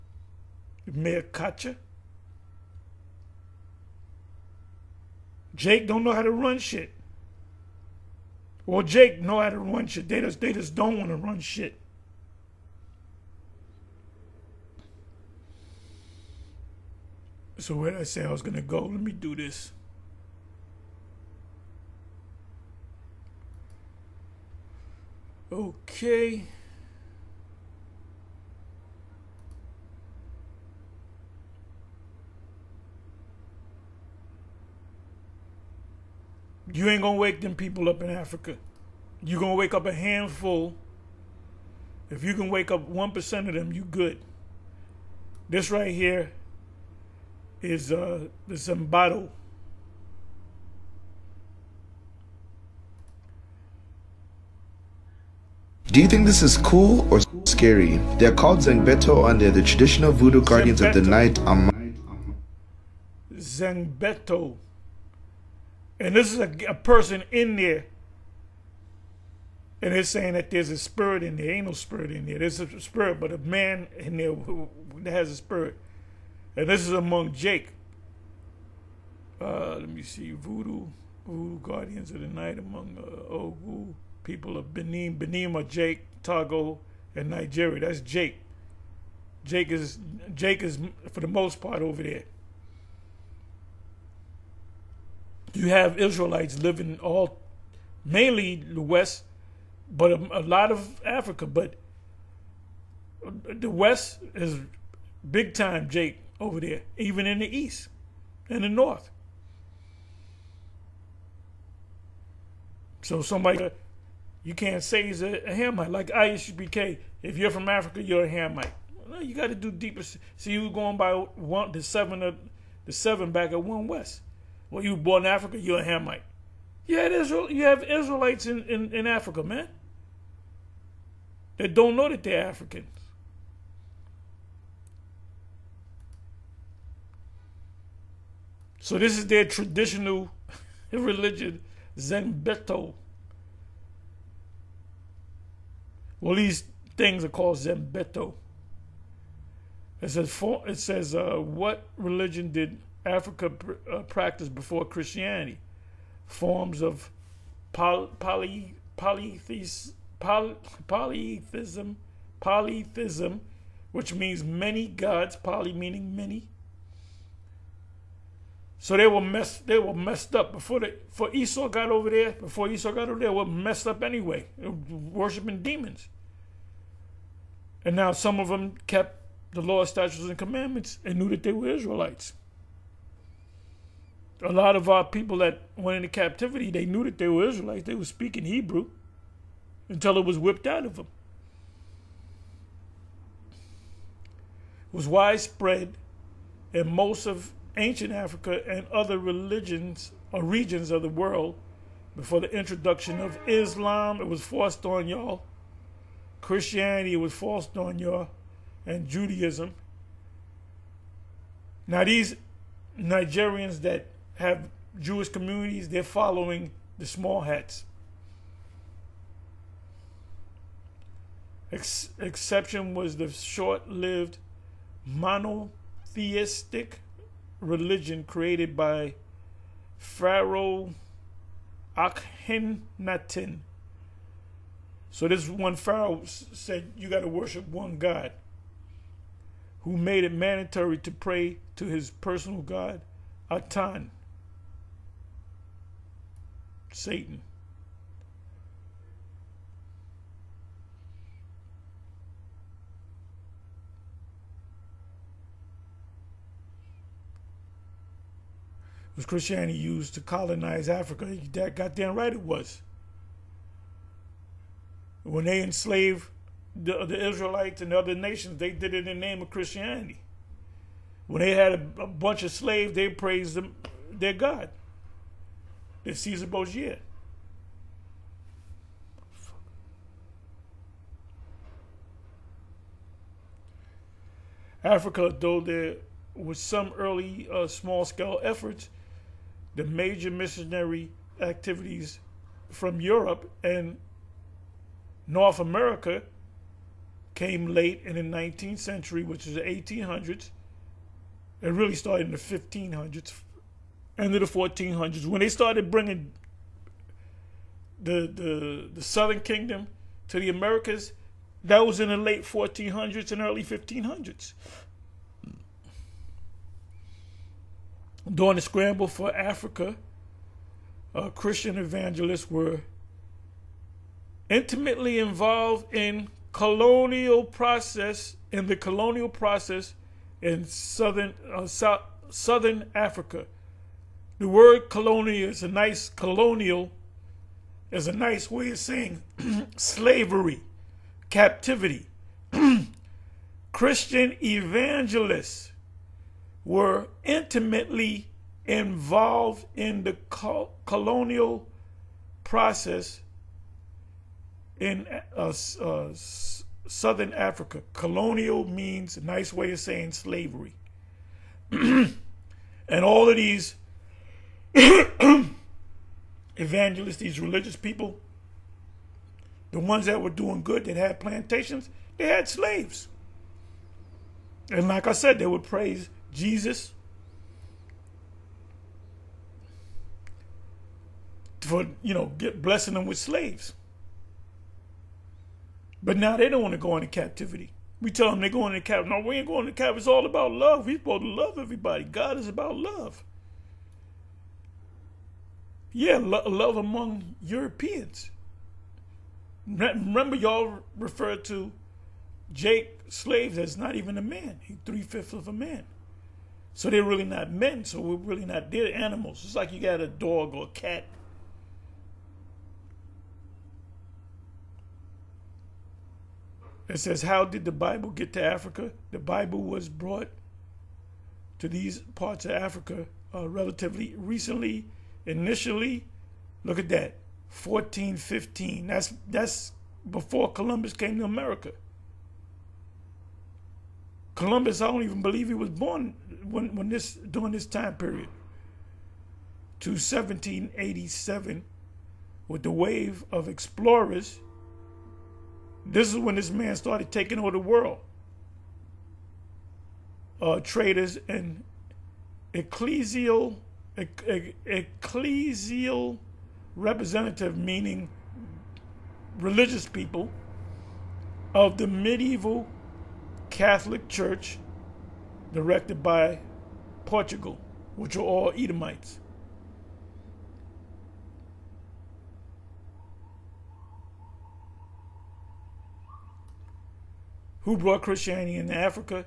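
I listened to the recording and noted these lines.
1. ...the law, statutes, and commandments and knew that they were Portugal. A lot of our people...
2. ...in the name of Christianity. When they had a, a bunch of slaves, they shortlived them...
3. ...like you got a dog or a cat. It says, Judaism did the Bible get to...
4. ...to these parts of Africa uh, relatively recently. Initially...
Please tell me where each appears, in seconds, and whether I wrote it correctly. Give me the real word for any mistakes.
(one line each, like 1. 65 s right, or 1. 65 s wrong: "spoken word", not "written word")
1. 179 s wrong: "Israelites", not "Portugal"
2. 269 s wrong: "praised", not "shortlived"
3. 409 s wrong: "How", not "Judaism"
4. 421 s right.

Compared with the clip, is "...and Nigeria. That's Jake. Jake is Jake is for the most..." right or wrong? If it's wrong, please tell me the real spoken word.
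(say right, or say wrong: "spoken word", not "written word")
right.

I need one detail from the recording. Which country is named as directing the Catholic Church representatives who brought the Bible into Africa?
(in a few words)
Portugal.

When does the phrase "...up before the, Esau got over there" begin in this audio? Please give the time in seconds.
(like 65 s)
170 s.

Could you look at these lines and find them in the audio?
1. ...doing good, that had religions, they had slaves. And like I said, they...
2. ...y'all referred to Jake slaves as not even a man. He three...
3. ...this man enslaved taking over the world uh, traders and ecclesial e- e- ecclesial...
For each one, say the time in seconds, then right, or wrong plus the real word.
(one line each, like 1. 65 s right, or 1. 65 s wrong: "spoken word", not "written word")
1. 370 s wrong: "plantations", not "religions"
2. 400 s right
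3. 446 s wrong: "started", not "enslaved".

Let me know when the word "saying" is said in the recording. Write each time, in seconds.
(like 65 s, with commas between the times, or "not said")
70 s, 338 s, 359 s.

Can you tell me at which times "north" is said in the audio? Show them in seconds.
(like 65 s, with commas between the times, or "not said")
108 s, 295 s.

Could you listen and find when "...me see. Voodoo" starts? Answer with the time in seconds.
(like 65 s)
79 s.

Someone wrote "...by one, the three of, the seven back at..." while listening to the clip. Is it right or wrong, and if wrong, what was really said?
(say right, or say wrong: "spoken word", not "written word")
wrong: "seven", not "three".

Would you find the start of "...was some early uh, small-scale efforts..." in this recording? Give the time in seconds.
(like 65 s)
286 s.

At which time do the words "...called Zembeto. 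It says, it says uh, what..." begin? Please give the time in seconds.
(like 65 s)
147 s.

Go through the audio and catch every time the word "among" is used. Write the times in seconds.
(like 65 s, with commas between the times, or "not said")
76 s, 82 s, 396 s.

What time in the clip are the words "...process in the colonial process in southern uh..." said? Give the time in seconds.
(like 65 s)
327 s.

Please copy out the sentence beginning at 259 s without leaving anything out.
was Christianity used to colonize Africa?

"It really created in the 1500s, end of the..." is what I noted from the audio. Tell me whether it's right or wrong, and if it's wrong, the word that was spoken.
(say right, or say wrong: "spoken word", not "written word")
wrong: "started", not "created".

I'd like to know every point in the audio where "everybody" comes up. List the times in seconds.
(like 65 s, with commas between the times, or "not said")
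391 s.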